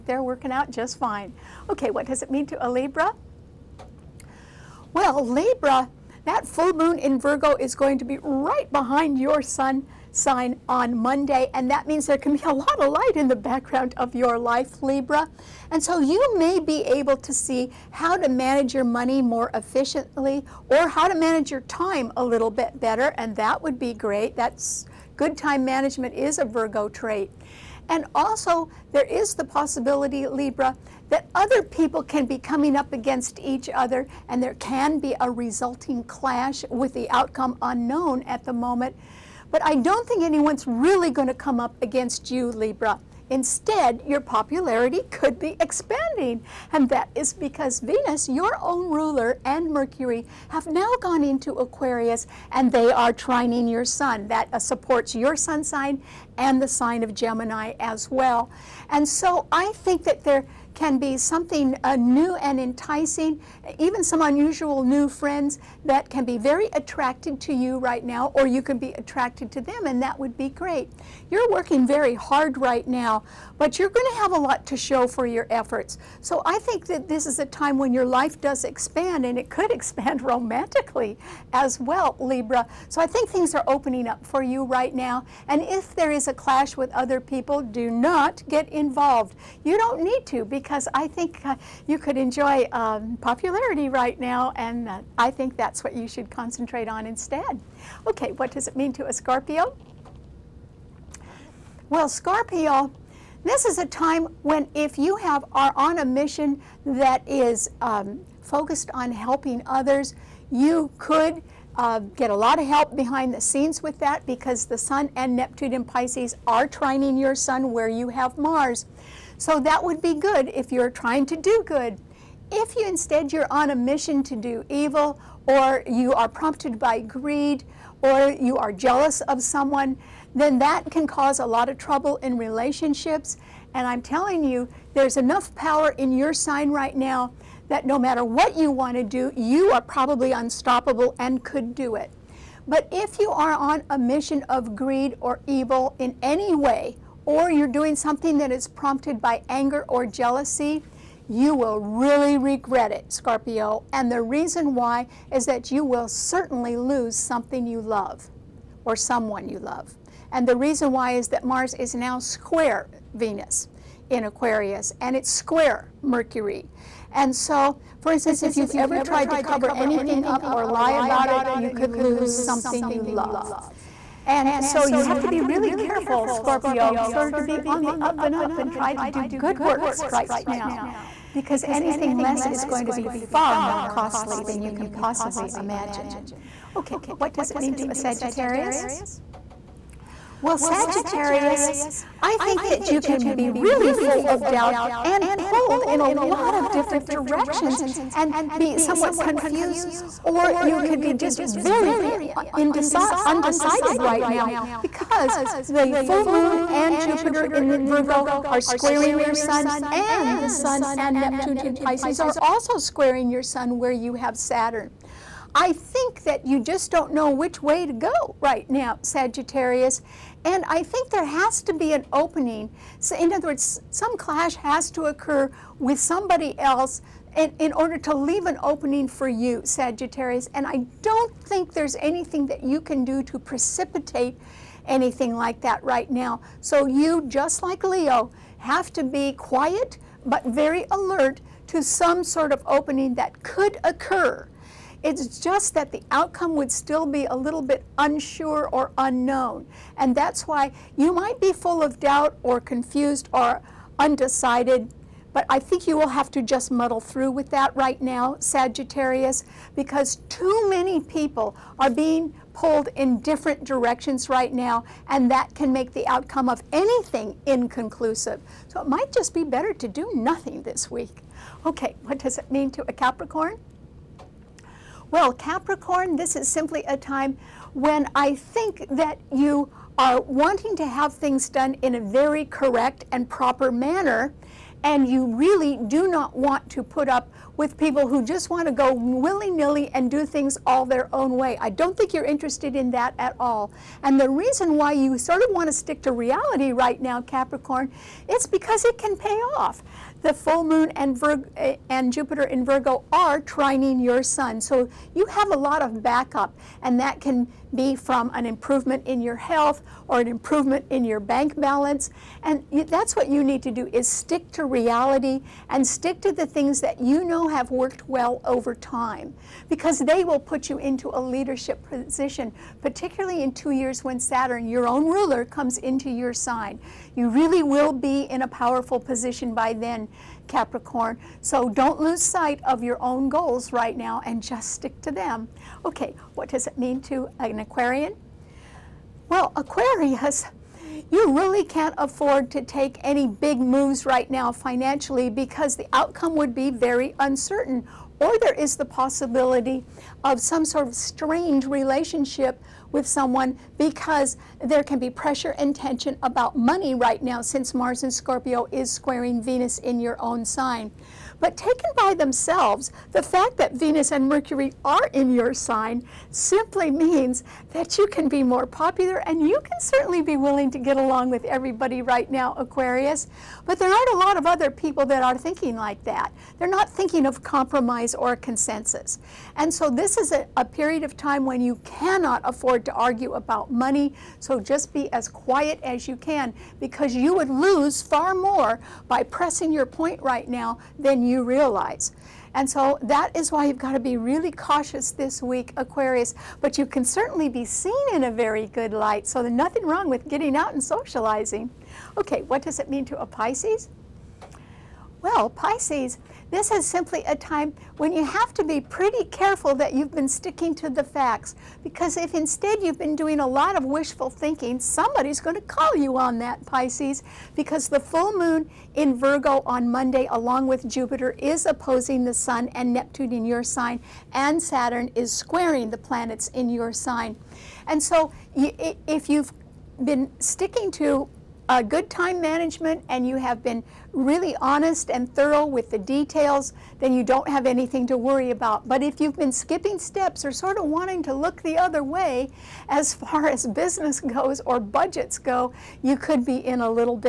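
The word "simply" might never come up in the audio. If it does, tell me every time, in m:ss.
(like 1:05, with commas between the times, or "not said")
4:36, 6:06, 6:46.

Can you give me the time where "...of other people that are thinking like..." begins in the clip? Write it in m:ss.
6:14.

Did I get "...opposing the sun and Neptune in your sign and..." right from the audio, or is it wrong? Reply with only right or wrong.
right.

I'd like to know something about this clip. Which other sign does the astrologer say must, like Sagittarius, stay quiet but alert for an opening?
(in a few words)
Leo.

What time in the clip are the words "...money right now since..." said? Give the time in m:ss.
5:56.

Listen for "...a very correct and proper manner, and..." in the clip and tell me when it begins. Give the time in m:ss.
4:41.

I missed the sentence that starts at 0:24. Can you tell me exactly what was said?
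That's good time management is a Virgo trait.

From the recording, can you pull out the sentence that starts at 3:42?
So in other words, some clash has to occur with somebody else in, in, order to leave an opening for you, Sagittarius.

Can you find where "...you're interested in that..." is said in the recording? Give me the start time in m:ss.
4:52.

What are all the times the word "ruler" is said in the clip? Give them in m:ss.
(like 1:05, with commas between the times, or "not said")
0:48, 5:25.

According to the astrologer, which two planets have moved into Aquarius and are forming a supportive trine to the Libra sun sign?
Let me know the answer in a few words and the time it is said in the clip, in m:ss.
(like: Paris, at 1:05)
Venus and Mercury, at 0:47.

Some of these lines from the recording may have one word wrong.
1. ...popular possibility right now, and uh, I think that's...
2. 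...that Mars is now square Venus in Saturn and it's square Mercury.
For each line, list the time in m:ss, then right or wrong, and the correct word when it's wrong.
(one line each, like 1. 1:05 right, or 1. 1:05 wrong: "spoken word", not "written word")
1. 1:33 wrong: "popularity", not "possibility"
2. 2:41 wrong: "Aquarius", not "Saturn".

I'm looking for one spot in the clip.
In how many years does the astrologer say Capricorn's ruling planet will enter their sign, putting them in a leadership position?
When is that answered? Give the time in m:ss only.
5:23.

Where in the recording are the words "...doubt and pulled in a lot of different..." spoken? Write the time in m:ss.
3:14.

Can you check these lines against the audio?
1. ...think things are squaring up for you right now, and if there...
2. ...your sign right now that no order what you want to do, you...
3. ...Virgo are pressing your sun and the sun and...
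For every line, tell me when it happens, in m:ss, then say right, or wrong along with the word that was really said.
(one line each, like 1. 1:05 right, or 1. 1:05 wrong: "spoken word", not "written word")
1. 1:23 wrong: "opening", not "squaring"
2. 2:16 wrong: "matter", not "order"
3. 3:27 wrong: "squaring", not "pressing".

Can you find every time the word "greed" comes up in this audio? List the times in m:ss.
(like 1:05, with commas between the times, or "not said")
2:06, 2:24.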